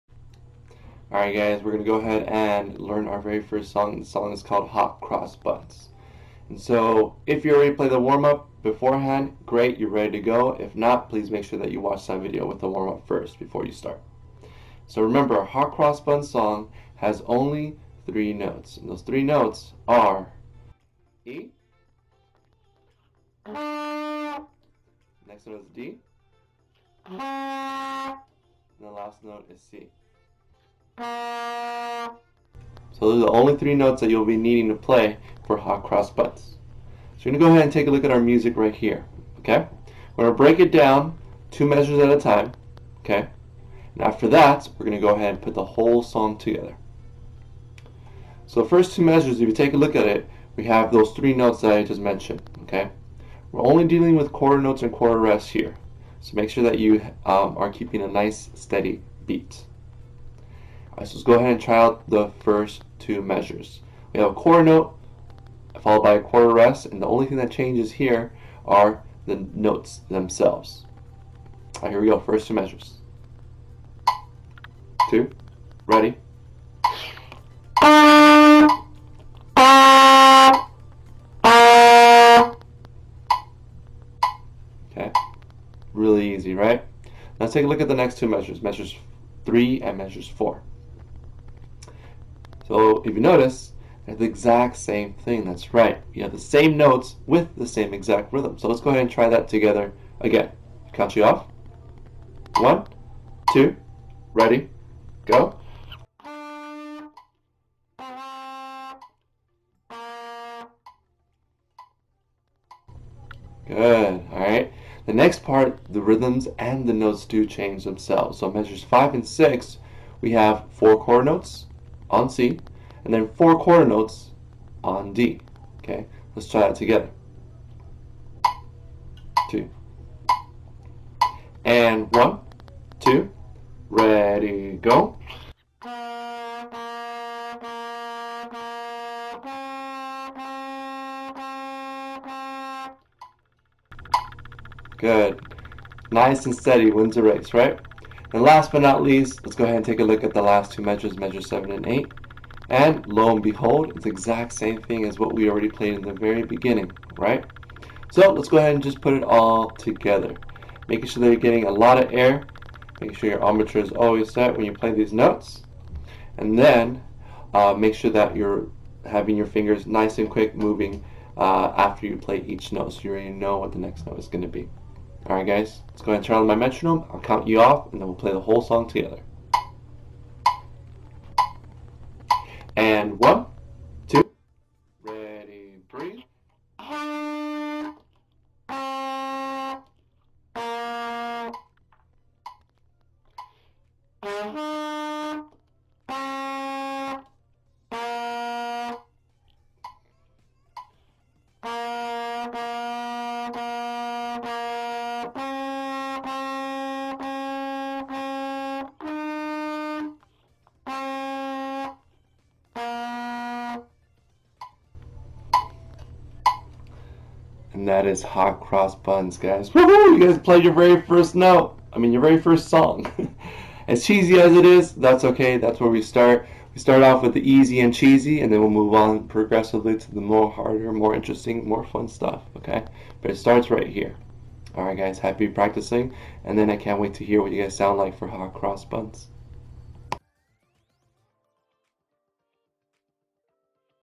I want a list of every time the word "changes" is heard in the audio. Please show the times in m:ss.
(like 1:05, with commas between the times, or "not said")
1:07, 1:57.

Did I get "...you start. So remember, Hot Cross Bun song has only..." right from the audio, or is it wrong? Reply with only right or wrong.
right.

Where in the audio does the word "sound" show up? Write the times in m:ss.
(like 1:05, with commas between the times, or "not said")
3:57.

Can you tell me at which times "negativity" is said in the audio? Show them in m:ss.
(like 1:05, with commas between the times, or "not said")
not said.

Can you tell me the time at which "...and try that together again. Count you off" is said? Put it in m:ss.
1:39.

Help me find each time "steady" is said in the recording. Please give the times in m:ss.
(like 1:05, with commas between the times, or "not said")
0:58, 2:26.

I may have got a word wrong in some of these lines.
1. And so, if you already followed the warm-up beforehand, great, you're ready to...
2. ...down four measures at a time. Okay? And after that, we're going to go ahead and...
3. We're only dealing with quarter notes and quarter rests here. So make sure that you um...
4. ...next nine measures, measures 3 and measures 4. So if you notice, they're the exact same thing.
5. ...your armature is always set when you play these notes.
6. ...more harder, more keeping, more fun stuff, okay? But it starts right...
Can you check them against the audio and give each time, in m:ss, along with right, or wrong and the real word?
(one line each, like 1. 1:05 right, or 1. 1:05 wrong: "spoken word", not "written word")
1. 0:06 wrong: "played", not "followed"
2. 0:40 wrong: "two", not "four"
3. 0:53 right
4. 1:27 wrong: "two", not "nine"
5. 2:43 right
6. 3:50 wrong: "interesting", not "keeping".